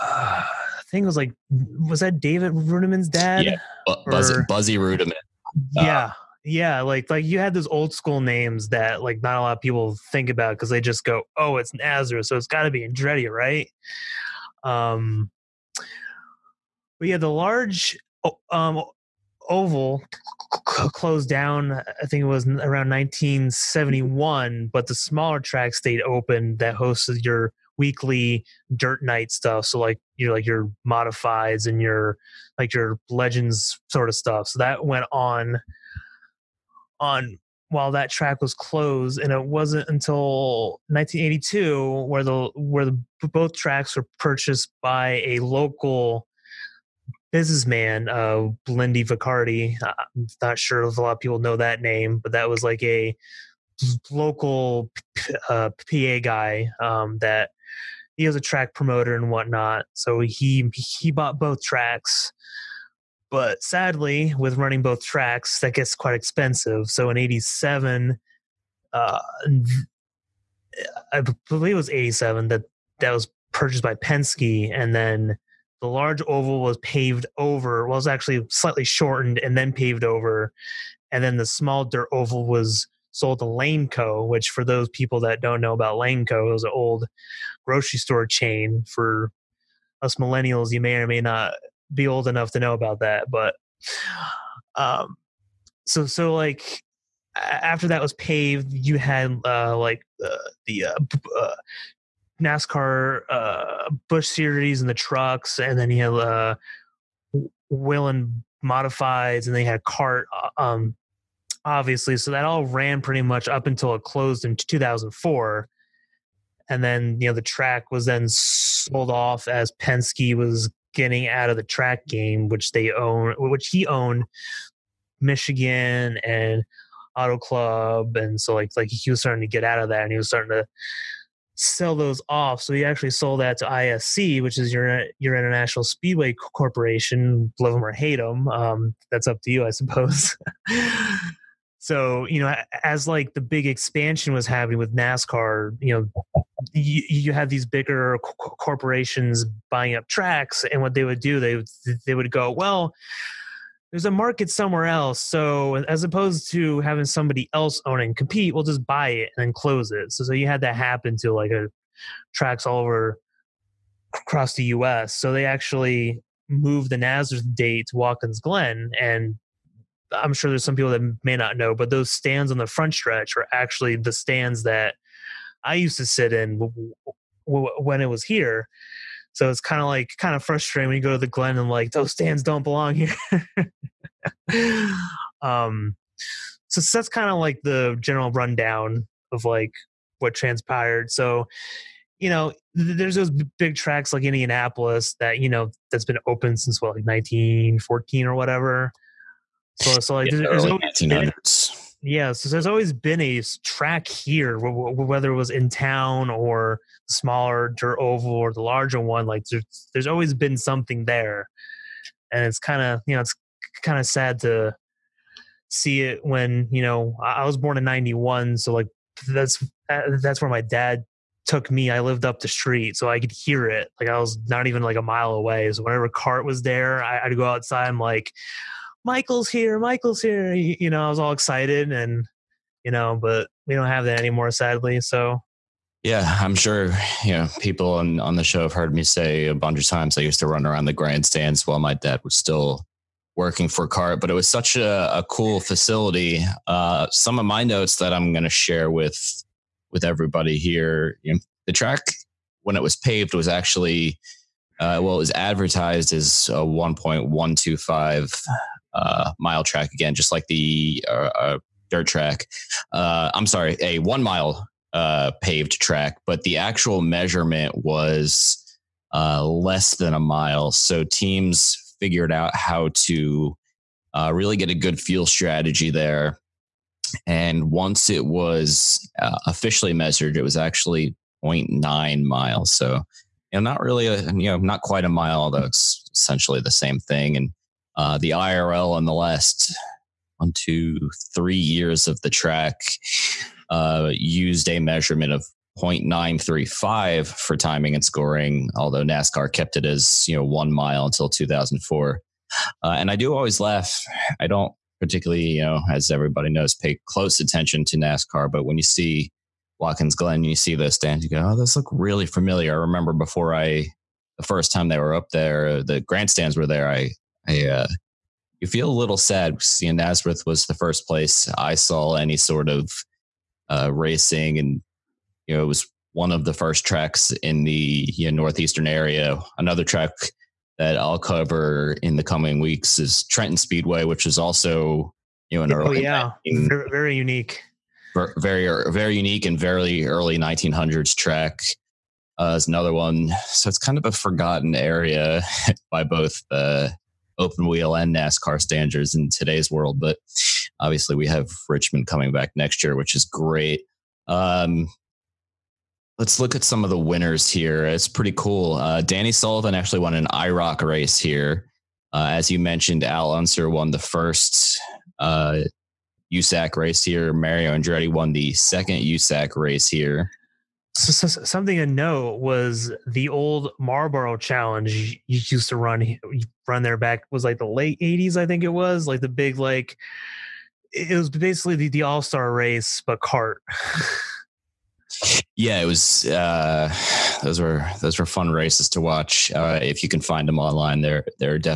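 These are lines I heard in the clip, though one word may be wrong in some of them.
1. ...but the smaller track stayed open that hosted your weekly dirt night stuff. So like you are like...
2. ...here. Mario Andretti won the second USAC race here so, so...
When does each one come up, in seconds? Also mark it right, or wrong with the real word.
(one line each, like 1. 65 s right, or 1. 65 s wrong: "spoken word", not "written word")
1. 24 s right
2. 367 s right.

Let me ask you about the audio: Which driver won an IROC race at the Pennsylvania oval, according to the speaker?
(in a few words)
Danny Sullivan.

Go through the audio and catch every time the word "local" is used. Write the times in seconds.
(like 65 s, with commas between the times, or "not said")
45 s, 54 s.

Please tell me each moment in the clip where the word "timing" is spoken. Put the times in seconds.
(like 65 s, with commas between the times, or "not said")
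297 s.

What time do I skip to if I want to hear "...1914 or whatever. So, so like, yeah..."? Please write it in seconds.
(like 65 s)
197 s.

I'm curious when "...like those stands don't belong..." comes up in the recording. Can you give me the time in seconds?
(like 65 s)
181 s.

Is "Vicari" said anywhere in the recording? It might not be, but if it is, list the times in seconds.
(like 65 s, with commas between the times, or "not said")
49 s.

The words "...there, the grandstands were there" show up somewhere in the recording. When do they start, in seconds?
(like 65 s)
315 s.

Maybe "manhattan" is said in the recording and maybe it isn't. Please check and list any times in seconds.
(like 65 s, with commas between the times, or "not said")
not said.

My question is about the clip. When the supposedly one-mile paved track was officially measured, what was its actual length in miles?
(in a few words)
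0.9 miles.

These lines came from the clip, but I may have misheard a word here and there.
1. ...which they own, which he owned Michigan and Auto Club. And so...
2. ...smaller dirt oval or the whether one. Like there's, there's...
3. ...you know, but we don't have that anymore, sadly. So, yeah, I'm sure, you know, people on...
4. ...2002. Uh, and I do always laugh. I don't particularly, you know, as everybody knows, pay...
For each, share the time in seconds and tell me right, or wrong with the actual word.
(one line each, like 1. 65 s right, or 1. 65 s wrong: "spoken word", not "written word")
1. 122 s right
2. 207 s wrong: "larger", not "whether"
3. 232 s right
4. 301 s wrong: "2004", not "2002".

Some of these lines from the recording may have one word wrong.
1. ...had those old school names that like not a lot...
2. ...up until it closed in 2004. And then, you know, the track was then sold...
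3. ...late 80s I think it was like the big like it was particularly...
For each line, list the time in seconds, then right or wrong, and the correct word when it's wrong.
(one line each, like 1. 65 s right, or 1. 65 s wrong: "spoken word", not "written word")
1. 7 s right
2. 113 s right
3. 377 s wrong: "basically", not "particularly".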